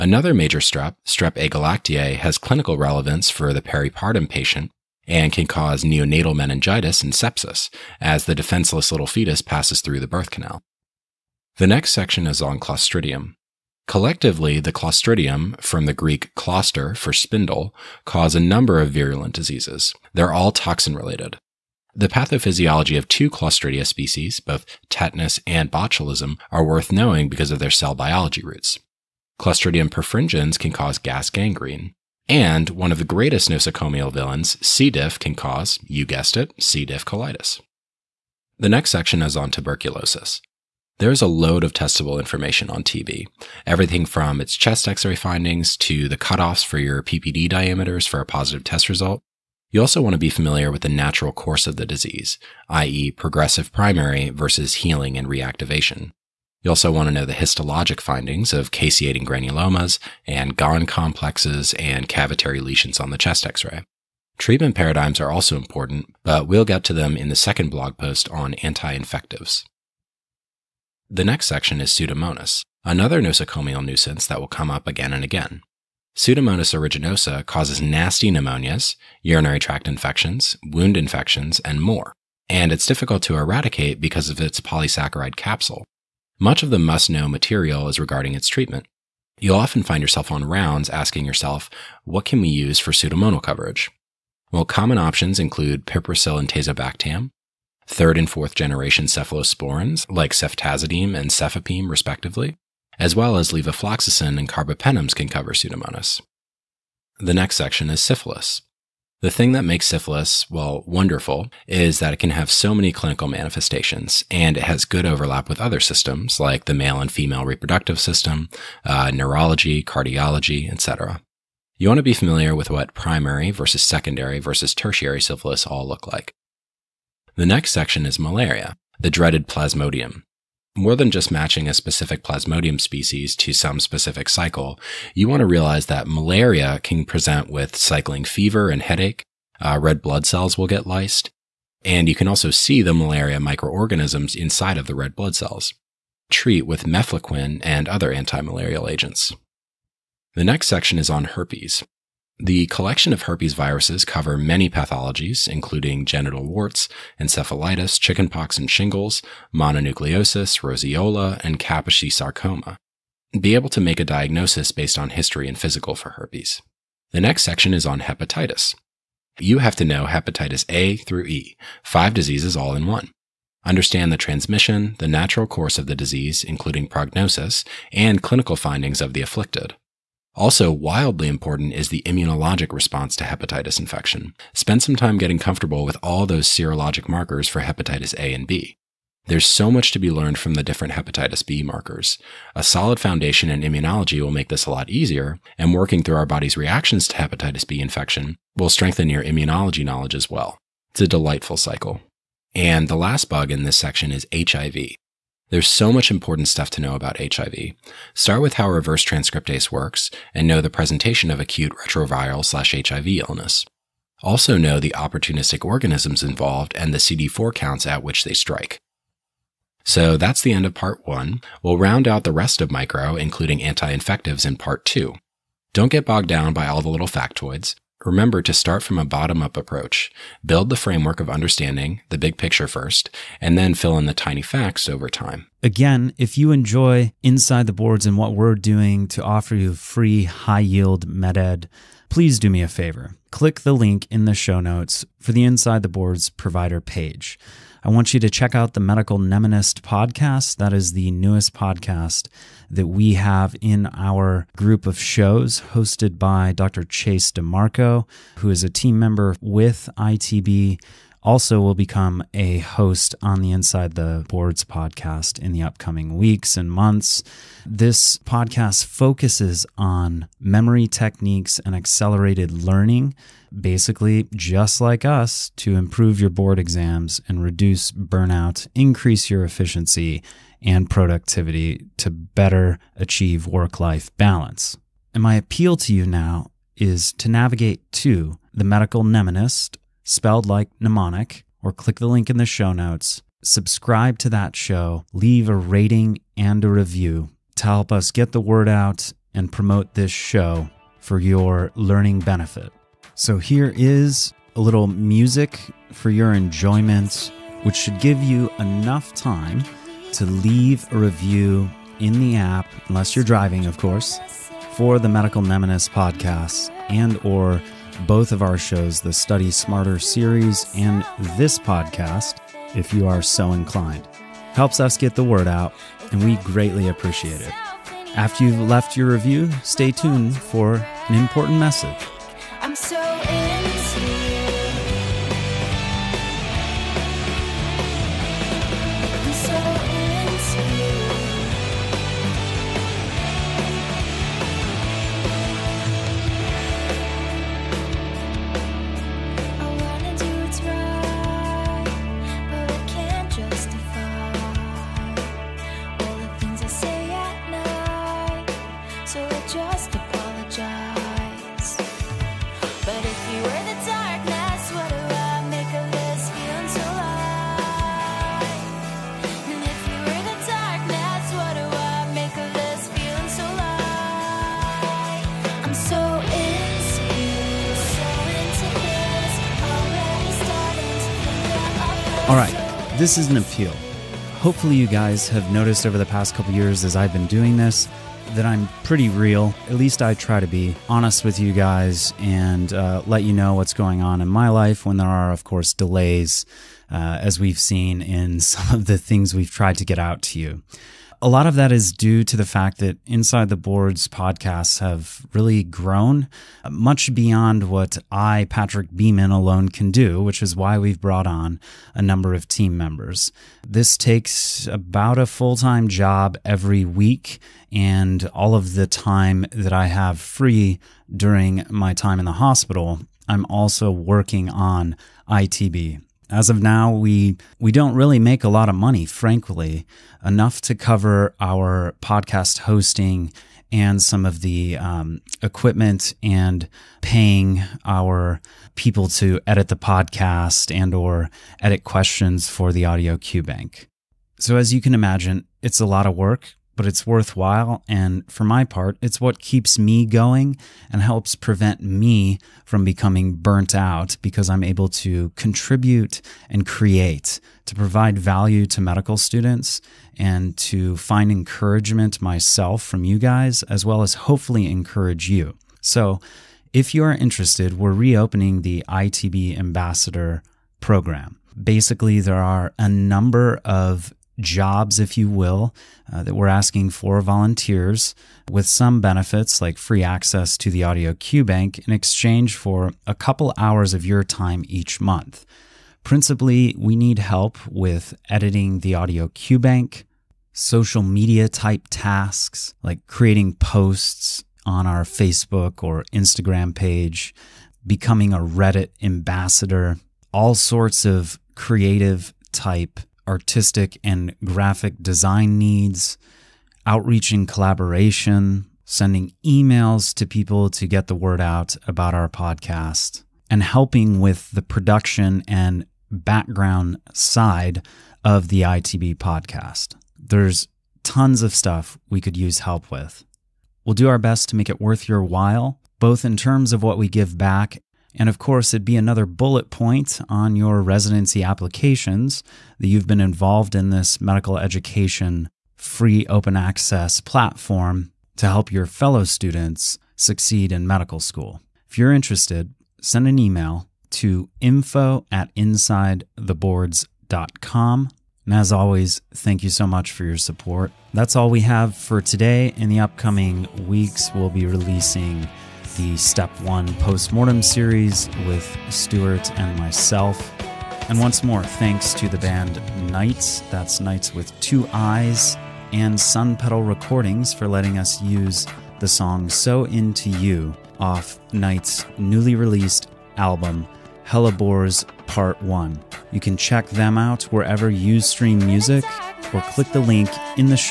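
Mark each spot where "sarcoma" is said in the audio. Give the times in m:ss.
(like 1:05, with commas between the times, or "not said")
2:42.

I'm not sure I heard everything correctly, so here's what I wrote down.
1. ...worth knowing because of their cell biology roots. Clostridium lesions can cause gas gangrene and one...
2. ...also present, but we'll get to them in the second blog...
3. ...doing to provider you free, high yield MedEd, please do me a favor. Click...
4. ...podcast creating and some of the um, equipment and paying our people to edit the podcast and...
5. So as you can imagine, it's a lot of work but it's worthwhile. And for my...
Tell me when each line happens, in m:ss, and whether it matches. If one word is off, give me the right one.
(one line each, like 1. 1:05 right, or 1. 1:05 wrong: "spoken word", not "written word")
1. 0:26 wrong: "perfringens", not "lesions"
2. 1:05 wrong: "important", not "present"
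3. 3:58 wrong: "offer", not "provider"
4. 7:12 wrong: "hosting", not "creating"
5. 7:24 right.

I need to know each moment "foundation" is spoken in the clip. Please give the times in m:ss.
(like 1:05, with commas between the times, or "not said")
3:12.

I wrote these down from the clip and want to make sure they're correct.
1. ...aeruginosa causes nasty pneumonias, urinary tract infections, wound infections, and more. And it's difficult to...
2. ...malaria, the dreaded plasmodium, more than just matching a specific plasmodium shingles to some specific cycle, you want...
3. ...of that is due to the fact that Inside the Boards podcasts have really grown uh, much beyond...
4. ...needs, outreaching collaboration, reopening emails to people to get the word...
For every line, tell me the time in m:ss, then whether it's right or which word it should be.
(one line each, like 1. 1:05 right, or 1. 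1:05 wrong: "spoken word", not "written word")
1. 1:16 right
2. 2:08 wrong: "species", not "shingles"
3. 6:41 right
4. 8:25 wrong: "sending", not "reopening".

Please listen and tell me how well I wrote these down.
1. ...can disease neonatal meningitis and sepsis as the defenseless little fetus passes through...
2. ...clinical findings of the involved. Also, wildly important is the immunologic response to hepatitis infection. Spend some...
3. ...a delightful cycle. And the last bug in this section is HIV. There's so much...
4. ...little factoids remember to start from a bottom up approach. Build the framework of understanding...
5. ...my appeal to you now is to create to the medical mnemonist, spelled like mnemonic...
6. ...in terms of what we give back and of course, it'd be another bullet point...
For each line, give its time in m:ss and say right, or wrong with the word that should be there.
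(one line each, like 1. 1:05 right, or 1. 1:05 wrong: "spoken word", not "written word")
1. 0:05 wrong: "cause", not "disease"
2. 2:58 wrong: "afflicted", not "involved"
3. 3:21 right
4. 3:46 right
5. 4:45 wrong: "navigate", not "create"
6. 8:46 right.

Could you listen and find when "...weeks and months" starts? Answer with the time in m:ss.
4:26.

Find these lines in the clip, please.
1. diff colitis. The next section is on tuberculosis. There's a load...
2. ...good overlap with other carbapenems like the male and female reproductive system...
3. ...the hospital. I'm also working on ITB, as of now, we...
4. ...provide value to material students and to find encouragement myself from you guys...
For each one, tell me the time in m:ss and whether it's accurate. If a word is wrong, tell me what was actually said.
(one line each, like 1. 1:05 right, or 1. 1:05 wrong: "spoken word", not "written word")
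1. 0:36 right
2. 1:54 wrong: "systems", not "carbapenems"
3. 7:02 right
4. 7:37 wrong: "medical", not "material".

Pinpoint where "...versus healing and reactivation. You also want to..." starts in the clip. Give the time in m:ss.
0:54.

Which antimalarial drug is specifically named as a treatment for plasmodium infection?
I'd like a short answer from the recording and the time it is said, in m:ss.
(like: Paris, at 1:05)
mefloquine, at 2:26.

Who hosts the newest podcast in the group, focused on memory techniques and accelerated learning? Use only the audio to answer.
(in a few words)
Dr. Chase DiMarco.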